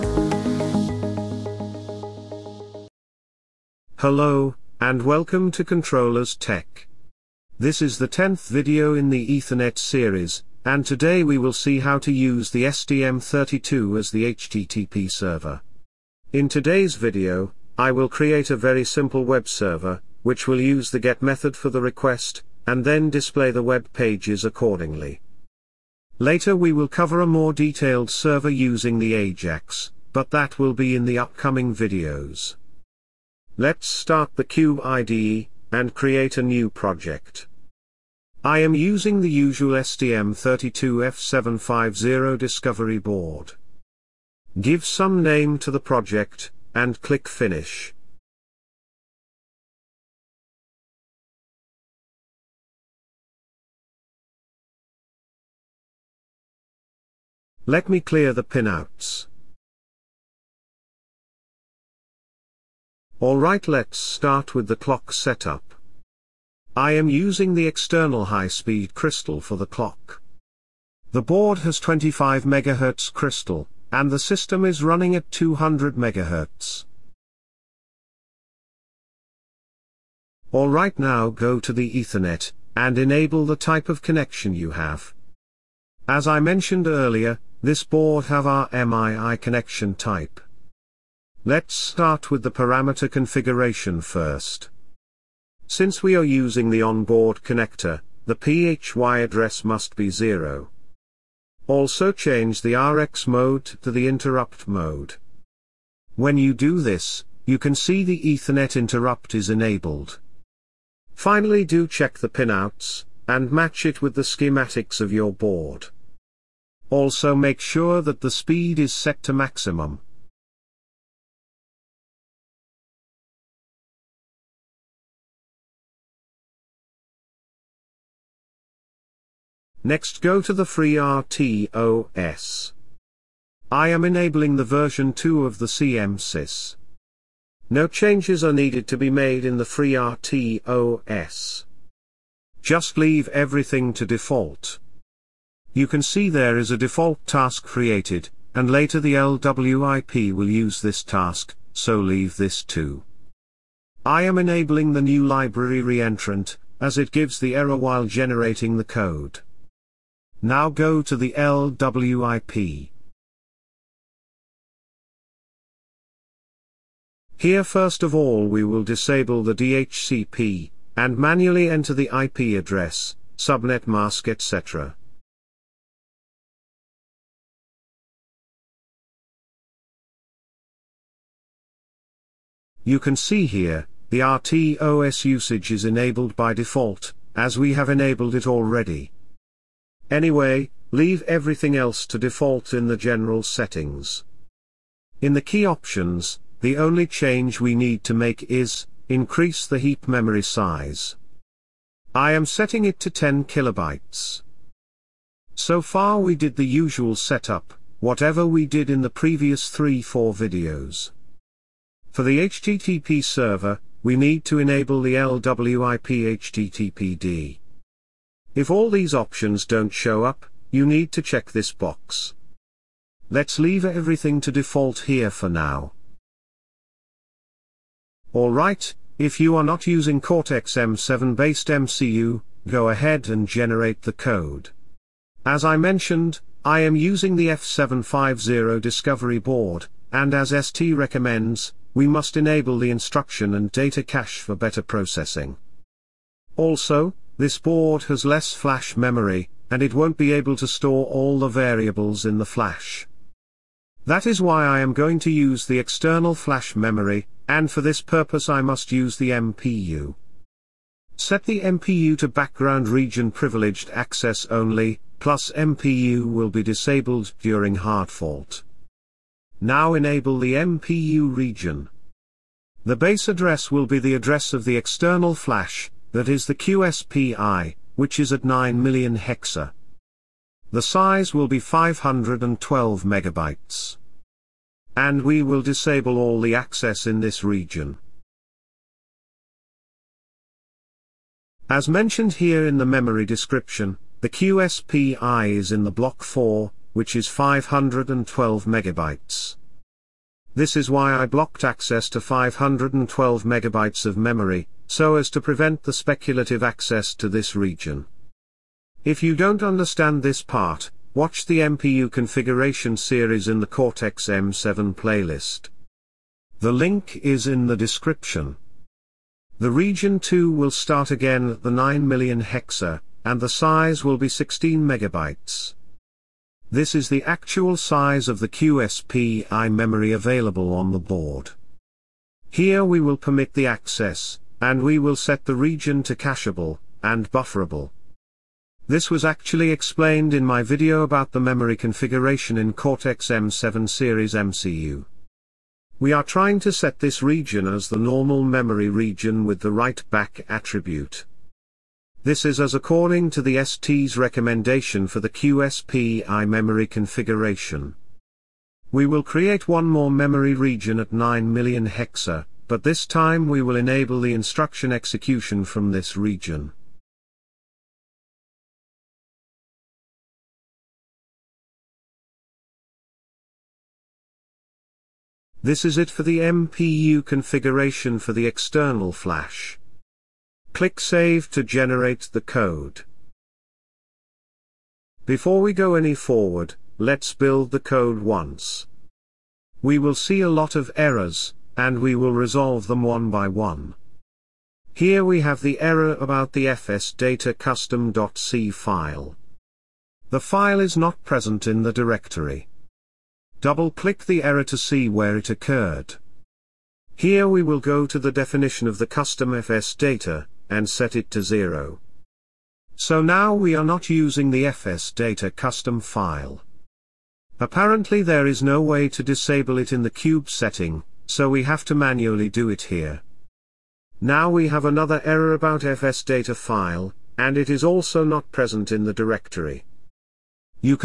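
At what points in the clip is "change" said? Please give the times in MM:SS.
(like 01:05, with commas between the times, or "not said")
01:42, 02:17, 03:17.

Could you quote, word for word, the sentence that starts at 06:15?
This is it for the MPU configuration for the external flash.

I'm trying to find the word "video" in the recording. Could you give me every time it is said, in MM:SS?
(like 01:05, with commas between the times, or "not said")
00:08, 00:16, 00:31, 03:30, 05:40.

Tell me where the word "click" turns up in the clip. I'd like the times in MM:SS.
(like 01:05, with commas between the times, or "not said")
00:47, 06:20, 06:43.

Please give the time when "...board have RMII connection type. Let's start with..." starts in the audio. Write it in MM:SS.
01:27.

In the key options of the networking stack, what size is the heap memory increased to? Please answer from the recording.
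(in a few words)
10 kilobytes.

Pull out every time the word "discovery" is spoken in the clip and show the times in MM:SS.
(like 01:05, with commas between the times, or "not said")
00:42, 03:58.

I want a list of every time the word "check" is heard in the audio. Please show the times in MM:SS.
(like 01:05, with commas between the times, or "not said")
01:51, 03:41.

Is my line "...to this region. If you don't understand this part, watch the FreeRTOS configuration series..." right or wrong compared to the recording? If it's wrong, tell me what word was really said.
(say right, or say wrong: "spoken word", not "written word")
wrong: "MPU", not "FreeRTOS".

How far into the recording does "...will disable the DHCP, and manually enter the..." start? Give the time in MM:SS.
02:48.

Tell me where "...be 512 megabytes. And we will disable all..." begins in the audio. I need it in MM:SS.
04:41.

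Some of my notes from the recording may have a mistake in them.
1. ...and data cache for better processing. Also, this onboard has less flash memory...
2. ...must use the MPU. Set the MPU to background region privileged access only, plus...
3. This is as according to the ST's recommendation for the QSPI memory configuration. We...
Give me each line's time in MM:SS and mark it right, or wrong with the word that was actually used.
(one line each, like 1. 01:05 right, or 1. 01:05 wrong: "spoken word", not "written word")
1. 04:03 wrong: "board", not "onboard"
2. 04:18 right
3. 05:52 right.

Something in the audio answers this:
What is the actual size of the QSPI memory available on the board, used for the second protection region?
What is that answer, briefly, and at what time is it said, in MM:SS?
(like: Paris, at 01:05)
16 megabytes, at 05:24.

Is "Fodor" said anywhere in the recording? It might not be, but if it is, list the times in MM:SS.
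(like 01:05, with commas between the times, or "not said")
not said.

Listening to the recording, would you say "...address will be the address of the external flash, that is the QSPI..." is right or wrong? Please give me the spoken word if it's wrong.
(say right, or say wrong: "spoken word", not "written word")
right.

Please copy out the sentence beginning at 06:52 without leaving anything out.
So now we are not using the fs data custom file.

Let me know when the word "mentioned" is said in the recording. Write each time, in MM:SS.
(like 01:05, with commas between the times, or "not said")
01:26, 03:55, 04:51.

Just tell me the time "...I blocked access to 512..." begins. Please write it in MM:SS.
05:01.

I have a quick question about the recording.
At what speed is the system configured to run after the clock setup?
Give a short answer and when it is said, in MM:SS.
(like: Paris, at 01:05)
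200 MHz, at 01:15.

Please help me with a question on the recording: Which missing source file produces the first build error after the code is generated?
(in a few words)
fs_data_custom.c.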